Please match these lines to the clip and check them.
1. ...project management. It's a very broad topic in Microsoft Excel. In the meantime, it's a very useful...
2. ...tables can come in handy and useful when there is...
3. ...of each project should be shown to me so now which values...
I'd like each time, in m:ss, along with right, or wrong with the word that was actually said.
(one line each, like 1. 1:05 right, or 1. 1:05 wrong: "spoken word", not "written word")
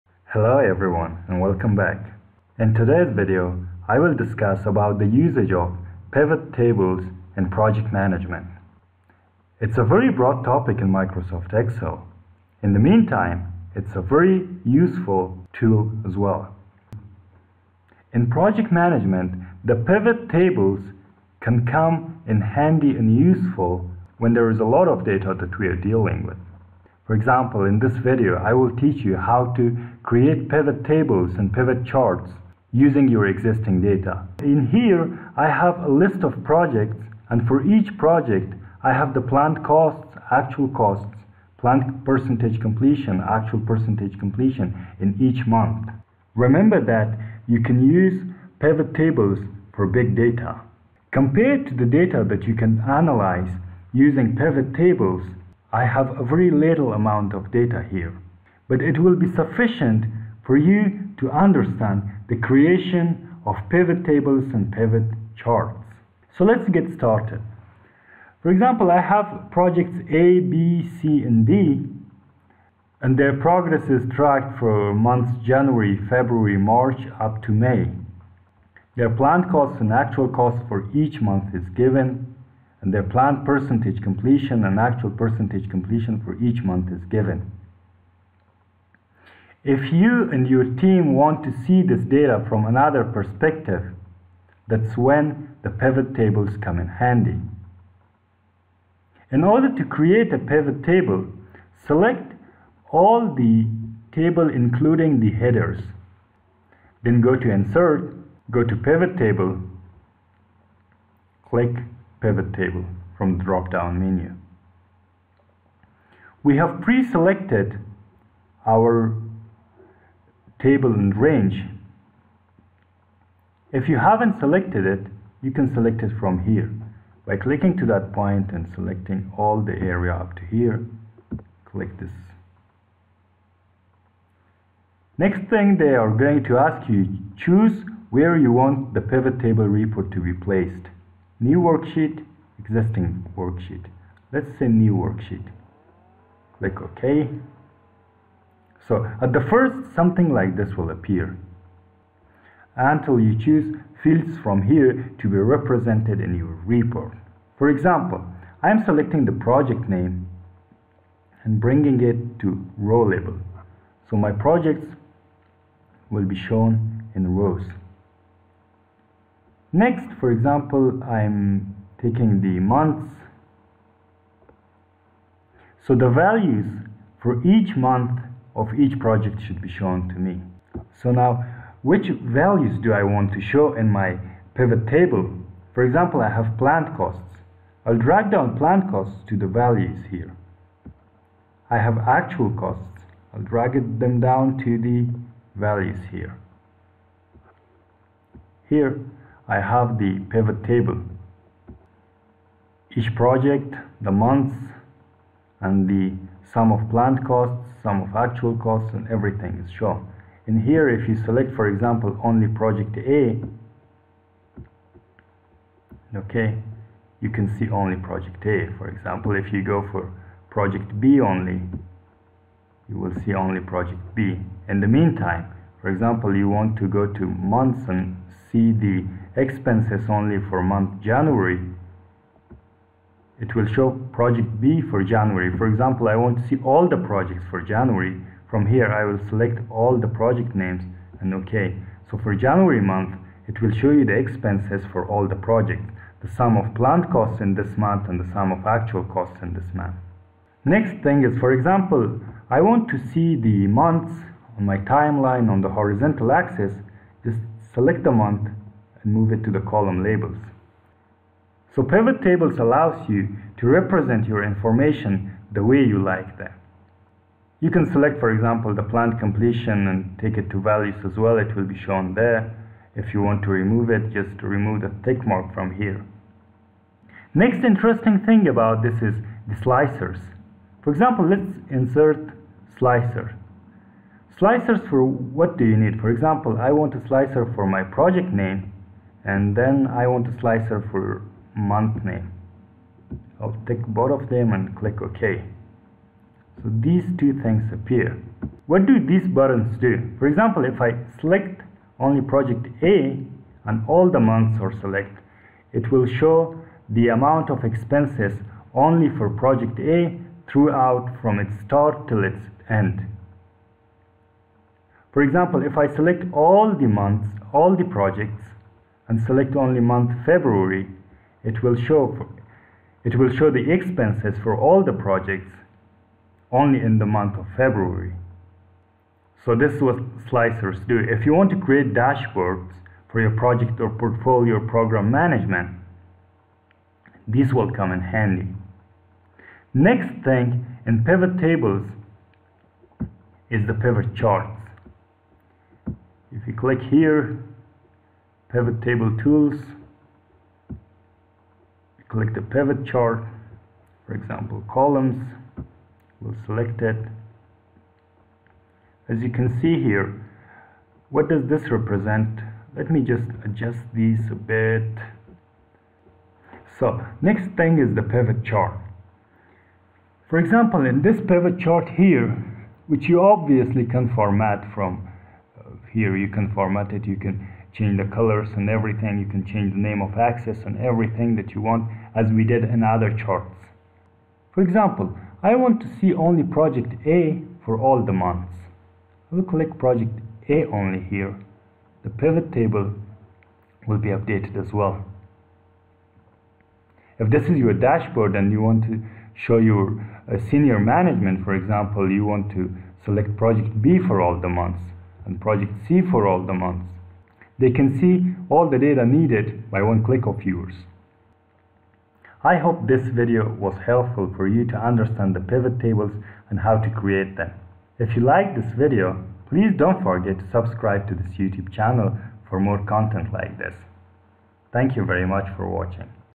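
1. 0:07 right
2. 0:20 right
3. 2:58 right.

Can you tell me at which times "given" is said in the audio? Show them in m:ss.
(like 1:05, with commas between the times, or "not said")
1:21, 1:27.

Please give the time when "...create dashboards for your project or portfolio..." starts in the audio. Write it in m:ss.
5:31.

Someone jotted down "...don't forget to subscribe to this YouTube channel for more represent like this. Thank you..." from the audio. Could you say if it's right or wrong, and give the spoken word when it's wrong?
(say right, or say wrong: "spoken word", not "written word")
wrong: "content", not "represent".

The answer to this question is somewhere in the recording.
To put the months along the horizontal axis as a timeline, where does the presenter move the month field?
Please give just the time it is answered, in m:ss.
4:19.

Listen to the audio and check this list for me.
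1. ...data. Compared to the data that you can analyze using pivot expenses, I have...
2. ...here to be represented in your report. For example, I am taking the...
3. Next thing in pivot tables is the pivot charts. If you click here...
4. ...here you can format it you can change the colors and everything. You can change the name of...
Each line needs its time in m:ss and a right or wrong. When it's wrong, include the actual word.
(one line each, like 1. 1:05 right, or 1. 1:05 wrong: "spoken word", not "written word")
1. 0:50 wrong: "tables", not "expenses"
2. 2:34 wrong: "selecting", not "taking"
3. 5:39 right
4. 6:15 right.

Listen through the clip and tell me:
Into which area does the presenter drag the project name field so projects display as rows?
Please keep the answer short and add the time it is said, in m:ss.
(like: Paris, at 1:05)
Row label, at 2:42.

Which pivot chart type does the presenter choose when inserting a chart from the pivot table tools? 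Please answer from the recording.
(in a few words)
Columns.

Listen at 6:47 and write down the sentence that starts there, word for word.
They can see all the data needed by one click of yours.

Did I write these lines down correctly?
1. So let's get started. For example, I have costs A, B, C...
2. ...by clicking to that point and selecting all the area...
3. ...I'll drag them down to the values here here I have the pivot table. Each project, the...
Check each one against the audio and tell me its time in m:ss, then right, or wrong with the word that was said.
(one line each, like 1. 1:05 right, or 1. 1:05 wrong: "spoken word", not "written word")
1. 1:06 wrong: "projects", not "costs"
2. 2:07 right
3. 3:13 right.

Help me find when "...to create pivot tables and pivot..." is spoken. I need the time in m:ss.
0:29.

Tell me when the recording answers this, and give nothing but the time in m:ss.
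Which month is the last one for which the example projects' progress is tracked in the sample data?
1:17.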